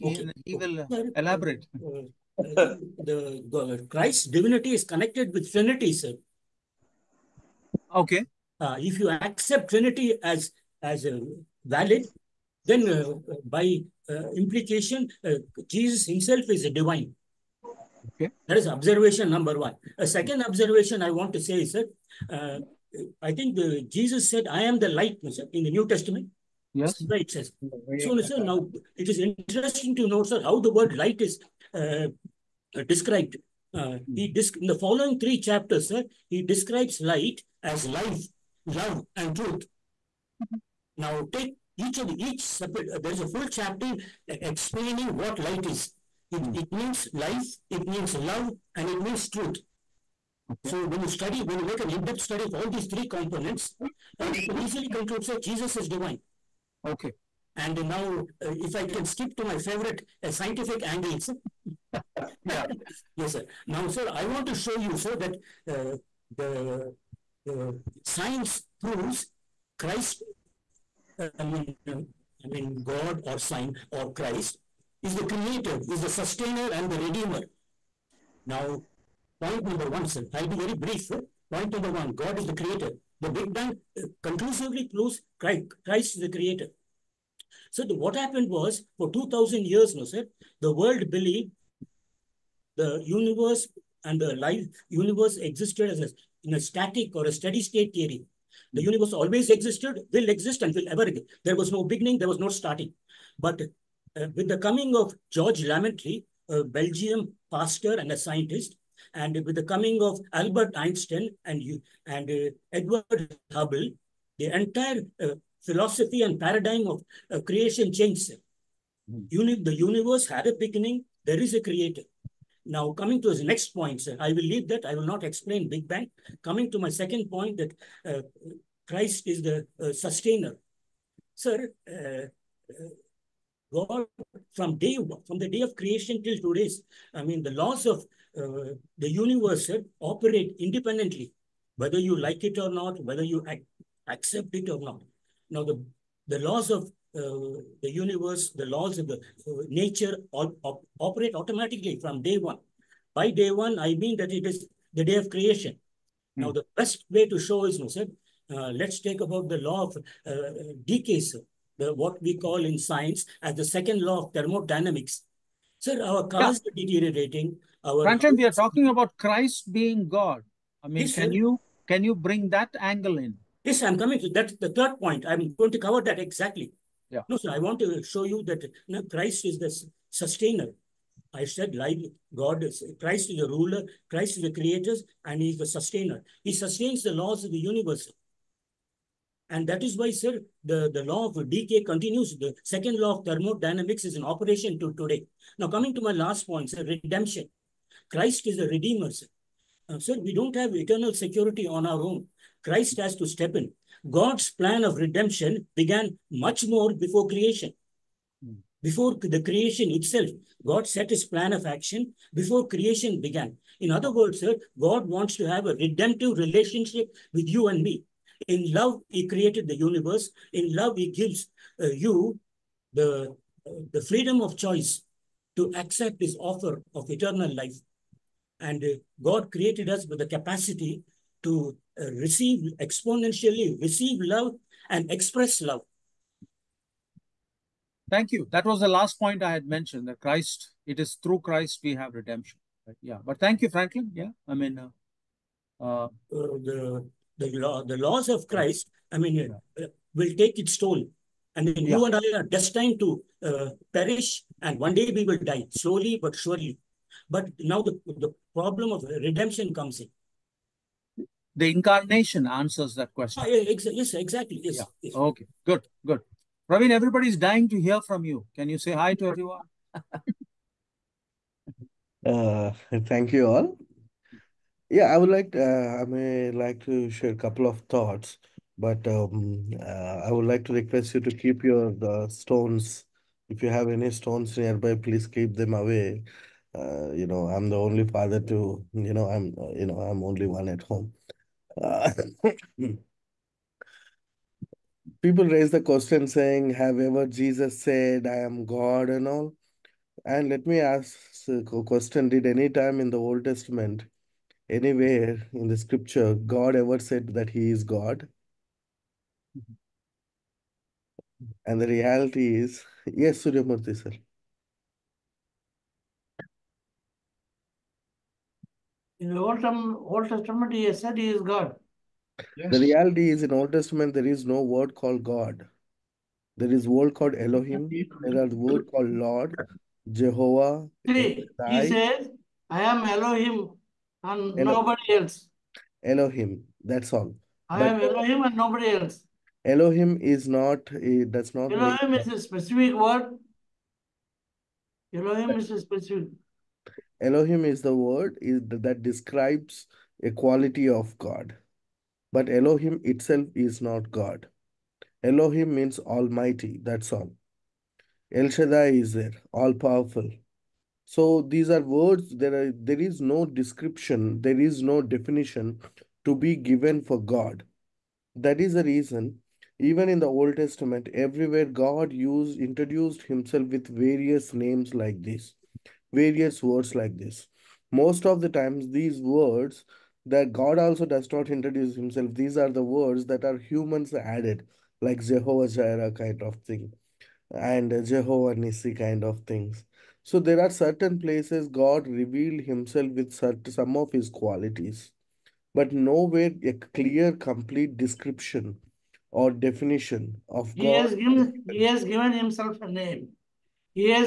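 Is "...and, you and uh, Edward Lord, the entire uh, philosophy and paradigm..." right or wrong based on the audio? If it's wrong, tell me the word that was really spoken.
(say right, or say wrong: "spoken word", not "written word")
wrong: "Hubble", not "Lord".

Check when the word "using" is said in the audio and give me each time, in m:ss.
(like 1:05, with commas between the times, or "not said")
not said.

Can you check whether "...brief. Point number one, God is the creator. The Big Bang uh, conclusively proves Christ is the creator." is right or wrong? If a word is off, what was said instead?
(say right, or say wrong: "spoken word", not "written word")
right.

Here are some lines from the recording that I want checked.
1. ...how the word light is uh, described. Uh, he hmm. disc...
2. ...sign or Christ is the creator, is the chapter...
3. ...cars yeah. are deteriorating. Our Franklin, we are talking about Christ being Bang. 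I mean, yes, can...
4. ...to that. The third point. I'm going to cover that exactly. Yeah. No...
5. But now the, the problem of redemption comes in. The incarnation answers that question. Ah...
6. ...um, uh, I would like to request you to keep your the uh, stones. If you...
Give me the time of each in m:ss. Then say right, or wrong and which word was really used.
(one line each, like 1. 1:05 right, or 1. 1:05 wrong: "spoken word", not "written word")
1. 0:30 right
2. 1:13 wrong: "sustainer", not "chapter"
3. 2:46 wrong: "God", not "Bang"
4. 2:54 right
5. 4:17 right
6. 4:39 right.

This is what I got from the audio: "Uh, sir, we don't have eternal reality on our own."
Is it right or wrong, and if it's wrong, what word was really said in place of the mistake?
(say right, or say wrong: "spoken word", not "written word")
wrong: "security", not "reality".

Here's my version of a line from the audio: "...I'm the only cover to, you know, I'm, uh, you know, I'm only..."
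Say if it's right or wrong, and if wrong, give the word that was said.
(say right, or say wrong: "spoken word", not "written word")
wrong: "father", not "cover".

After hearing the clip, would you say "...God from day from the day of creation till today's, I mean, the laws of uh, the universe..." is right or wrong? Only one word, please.
right.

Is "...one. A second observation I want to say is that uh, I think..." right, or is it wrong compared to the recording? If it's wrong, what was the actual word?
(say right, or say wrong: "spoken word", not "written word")
right.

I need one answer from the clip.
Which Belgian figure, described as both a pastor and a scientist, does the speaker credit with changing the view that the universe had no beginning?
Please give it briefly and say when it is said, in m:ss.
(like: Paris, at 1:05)
George Lemaître, at 1:45.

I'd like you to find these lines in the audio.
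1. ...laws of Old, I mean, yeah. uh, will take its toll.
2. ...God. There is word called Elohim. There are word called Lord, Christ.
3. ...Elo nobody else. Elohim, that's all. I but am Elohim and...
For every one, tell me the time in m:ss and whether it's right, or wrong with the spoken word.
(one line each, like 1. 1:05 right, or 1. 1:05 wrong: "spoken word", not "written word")
1. 4:07 wrong: "Christ", not "Old"
2. 5:25 wrong: "Jehovah", not "Christ"
3. 5:34 right.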